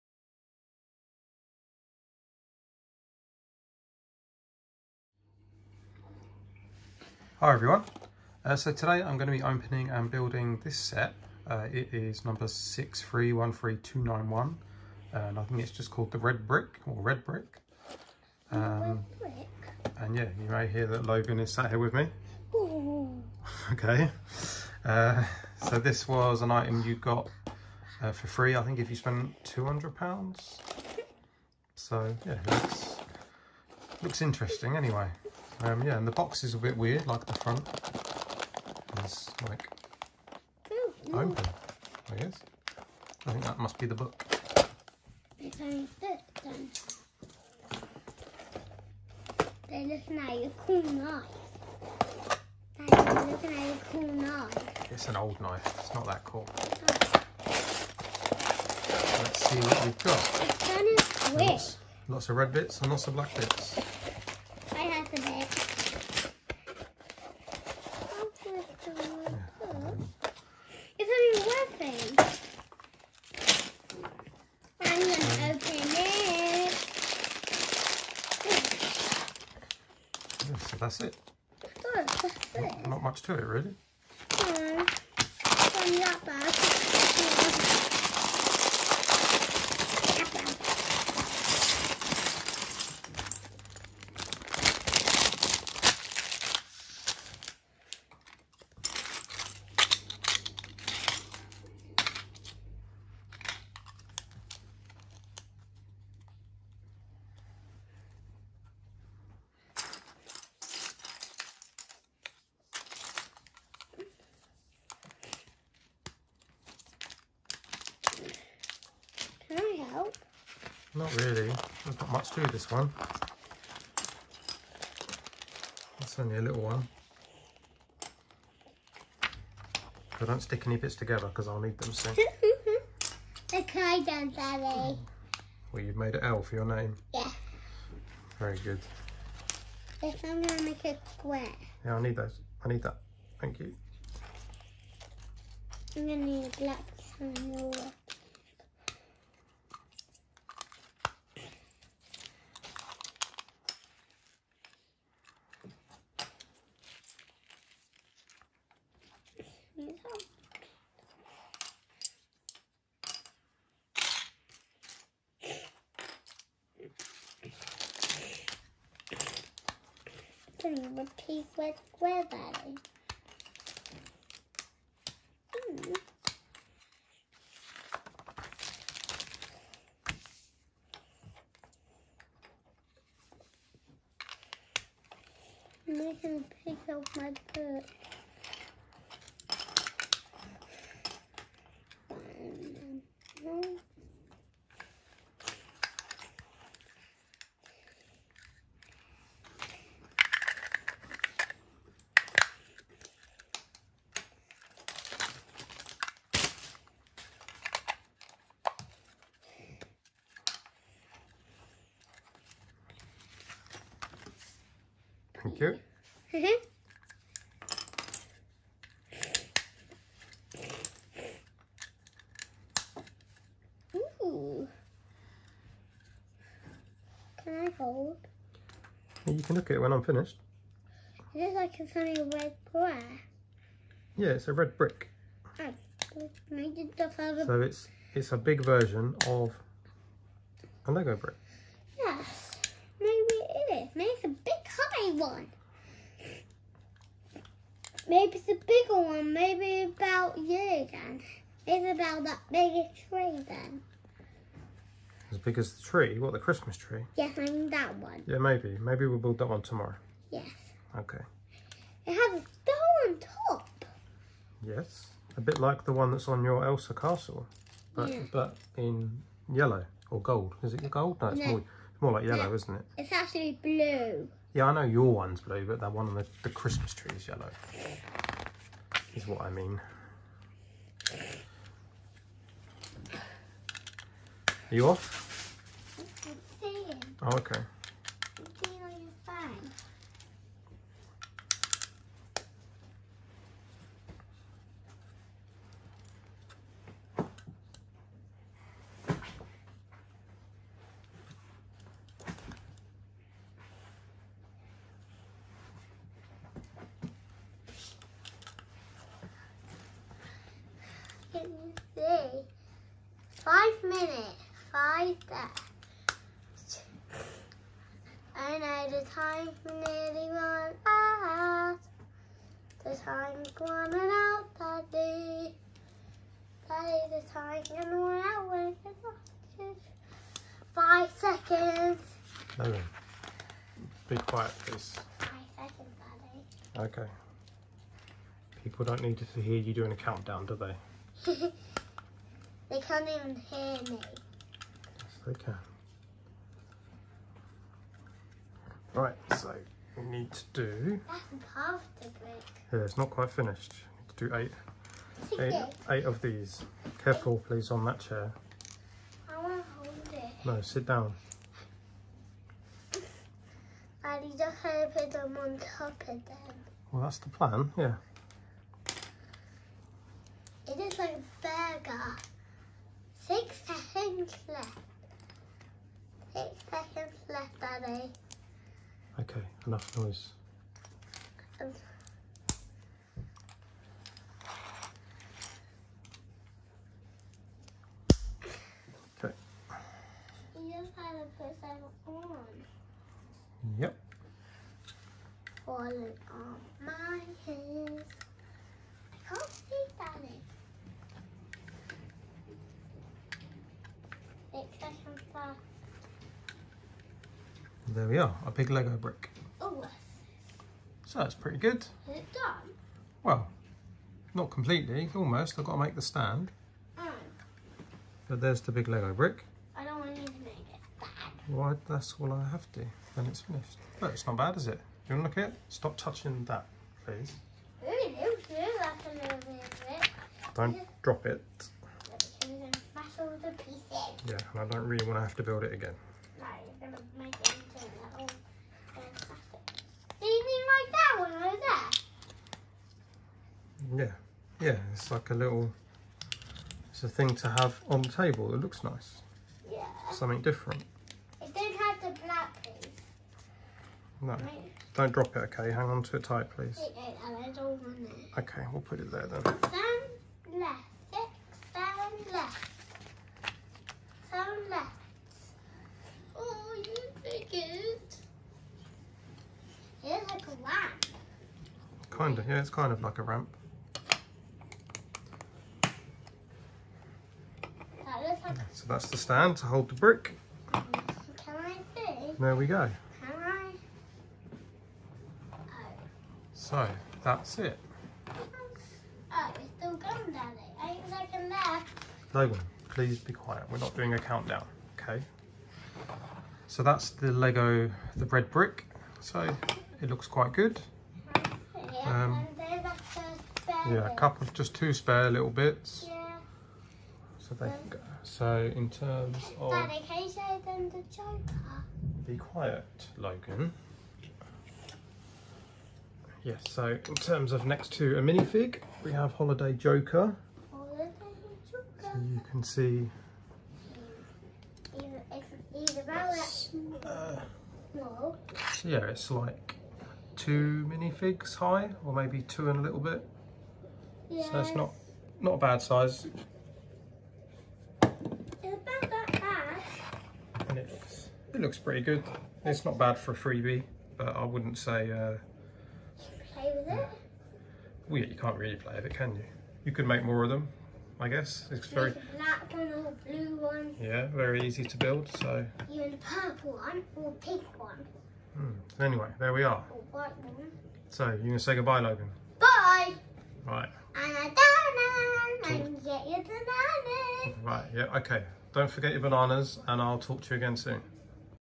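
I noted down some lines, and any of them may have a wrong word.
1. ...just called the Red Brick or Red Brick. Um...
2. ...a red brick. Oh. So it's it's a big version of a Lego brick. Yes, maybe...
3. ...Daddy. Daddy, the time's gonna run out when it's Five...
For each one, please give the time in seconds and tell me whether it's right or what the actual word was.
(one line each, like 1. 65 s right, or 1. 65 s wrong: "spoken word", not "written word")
1. 15 s right
2. 234 s right
3. 324 s right.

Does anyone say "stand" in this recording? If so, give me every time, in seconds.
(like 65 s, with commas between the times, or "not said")
416 s, 479 s.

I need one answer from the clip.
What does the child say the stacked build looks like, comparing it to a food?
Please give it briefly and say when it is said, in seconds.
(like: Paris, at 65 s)
A burger, at 370 s.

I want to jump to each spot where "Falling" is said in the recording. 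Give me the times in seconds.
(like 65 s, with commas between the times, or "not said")
395 s.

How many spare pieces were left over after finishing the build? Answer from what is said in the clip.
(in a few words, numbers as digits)
2.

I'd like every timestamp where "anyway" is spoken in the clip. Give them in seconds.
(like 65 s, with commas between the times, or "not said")
34 s, 559 s.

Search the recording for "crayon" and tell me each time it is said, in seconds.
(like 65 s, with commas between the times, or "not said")
133 s.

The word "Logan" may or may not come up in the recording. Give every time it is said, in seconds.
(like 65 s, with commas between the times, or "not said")
21 s, 492 s, 513 s, 561 s.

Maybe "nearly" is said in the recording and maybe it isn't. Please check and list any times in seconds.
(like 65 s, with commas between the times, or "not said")
319 s.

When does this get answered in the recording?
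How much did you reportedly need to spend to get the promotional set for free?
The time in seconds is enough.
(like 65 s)
29 s.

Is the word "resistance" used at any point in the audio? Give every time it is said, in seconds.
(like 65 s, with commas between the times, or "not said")
not said.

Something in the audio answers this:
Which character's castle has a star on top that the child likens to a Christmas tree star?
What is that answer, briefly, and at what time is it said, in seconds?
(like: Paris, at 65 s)
Elsa, at 266 s.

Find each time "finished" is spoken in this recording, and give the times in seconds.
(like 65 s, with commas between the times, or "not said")
230 s, 353 s, 423 s.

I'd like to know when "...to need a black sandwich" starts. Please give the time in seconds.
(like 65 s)
146 s.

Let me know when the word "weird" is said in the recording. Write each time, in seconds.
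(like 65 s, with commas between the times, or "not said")
36 s.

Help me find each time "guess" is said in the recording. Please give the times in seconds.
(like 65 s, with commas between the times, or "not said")
42 s, 551 s.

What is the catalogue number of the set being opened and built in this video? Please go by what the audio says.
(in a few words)
6313291.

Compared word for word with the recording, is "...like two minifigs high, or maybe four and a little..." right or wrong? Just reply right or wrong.
wrong.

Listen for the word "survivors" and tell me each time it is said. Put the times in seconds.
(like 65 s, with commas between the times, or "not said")
not said.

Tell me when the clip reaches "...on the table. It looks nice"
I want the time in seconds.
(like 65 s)
447 s.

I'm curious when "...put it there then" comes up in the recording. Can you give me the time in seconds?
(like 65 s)
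458 s.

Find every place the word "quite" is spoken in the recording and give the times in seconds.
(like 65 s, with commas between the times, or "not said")
353 s, 500 s.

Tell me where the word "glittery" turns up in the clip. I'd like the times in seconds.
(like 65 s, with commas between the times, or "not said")
not said.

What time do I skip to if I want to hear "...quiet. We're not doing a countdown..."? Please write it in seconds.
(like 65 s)
493 s.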